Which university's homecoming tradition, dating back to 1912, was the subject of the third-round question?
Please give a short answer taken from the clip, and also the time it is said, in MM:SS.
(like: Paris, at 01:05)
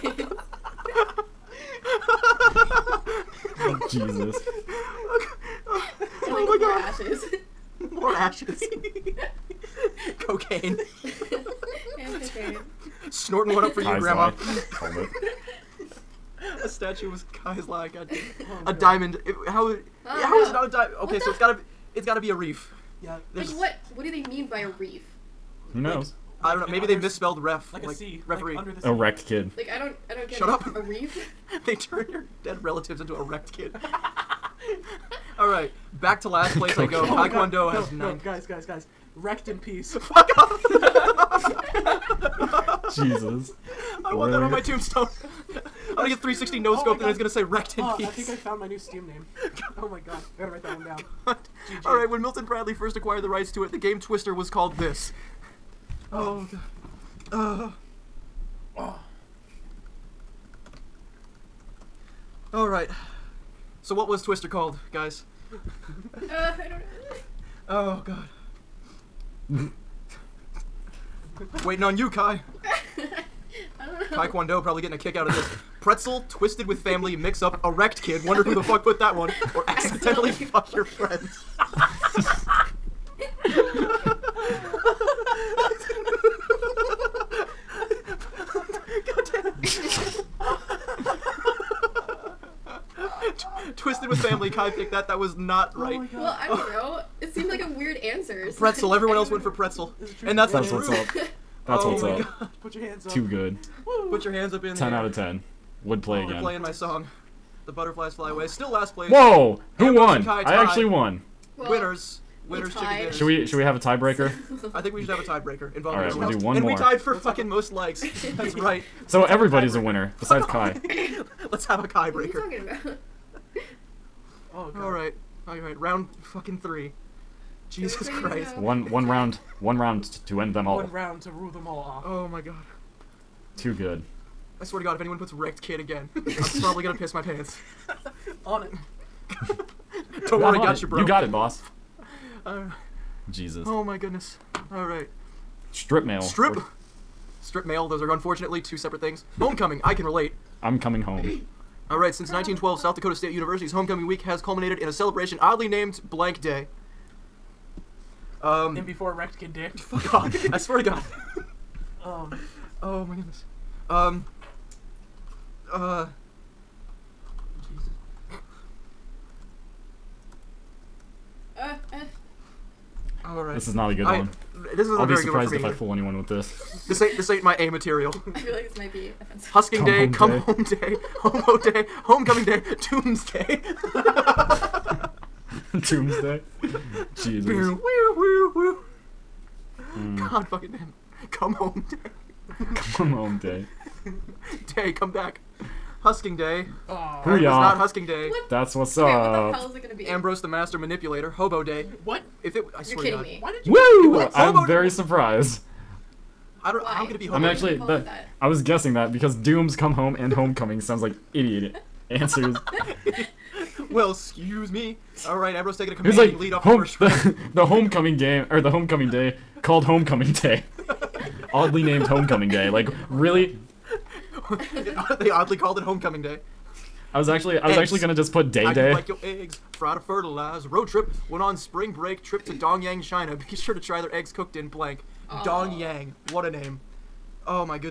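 South Dakota State University, at 02:32.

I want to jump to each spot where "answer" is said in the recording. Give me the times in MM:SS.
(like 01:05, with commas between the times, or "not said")
01:37, 03:32.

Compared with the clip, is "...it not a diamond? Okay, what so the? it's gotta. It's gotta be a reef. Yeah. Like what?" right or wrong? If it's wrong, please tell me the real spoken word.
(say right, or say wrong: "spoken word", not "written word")
right.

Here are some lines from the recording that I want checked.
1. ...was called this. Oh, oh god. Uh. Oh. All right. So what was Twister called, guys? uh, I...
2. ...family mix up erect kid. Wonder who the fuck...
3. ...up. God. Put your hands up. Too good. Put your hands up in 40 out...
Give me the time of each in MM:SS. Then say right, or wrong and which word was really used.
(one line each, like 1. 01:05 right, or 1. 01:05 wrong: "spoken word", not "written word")
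1. 00:54 right
2. 01:16 right
3. 01:42 wrong: "10", not "40".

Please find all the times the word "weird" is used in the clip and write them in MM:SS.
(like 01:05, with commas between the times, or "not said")
01:37.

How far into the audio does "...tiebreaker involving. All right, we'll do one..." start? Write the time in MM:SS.
01:55.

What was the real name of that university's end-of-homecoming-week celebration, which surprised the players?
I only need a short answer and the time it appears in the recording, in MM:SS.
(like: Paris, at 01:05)
Hobo Day, at 03:21.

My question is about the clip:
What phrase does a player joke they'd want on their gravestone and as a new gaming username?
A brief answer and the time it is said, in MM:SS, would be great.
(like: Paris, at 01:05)
Wrecked in peace, at 00:39.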